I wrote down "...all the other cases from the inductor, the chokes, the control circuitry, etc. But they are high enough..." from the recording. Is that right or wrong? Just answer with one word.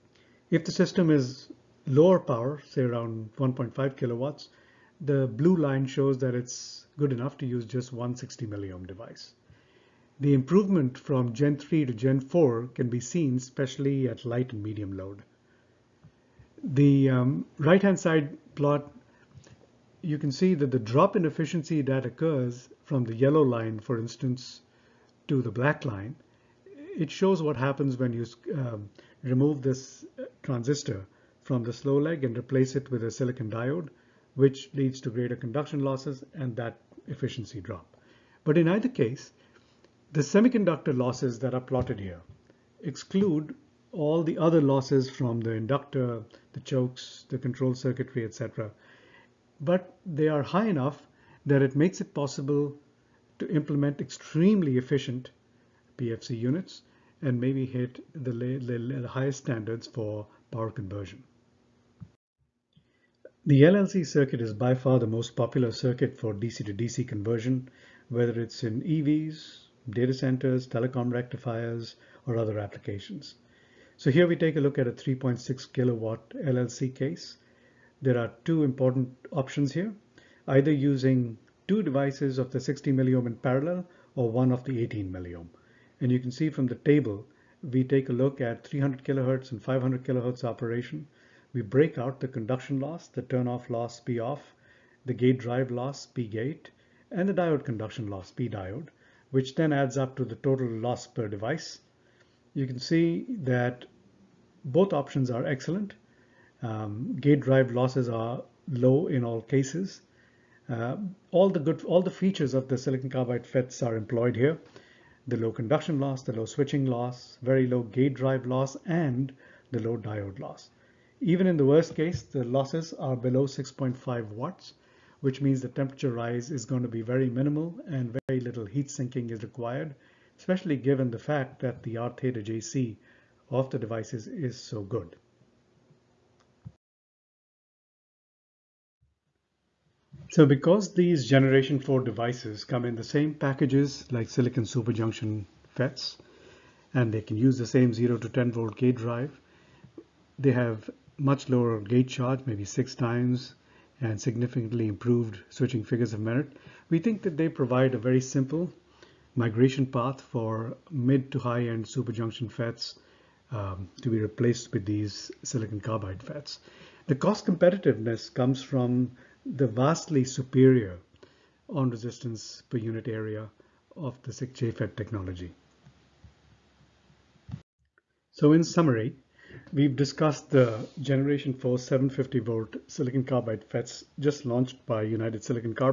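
wrong.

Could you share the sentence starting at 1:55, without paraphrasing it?
The low conduction loss, the low switching loss, very low gate drive loss, and the low diode loss.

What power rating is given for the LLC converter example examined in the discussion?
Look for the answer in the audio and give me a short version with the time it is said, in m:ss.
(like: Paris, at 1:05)
3.6 kilowatt, at 1:14.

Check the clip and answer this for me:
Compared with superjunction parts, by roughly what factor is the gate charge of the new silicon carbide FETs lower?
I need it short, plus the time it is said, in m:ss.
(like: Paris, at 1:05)
six times, at 2:32.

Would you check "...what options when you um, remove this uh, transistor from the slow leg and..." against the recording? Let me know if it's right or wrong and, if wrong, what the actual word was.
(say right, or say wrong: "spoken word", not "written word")
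wrong: "happens", not "options".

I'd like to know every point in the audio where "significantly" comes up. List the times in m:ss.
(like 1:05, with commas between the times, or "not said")
2:34.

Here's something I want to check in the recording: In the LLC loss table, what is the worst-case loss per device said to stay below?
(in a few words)
6.5 watts.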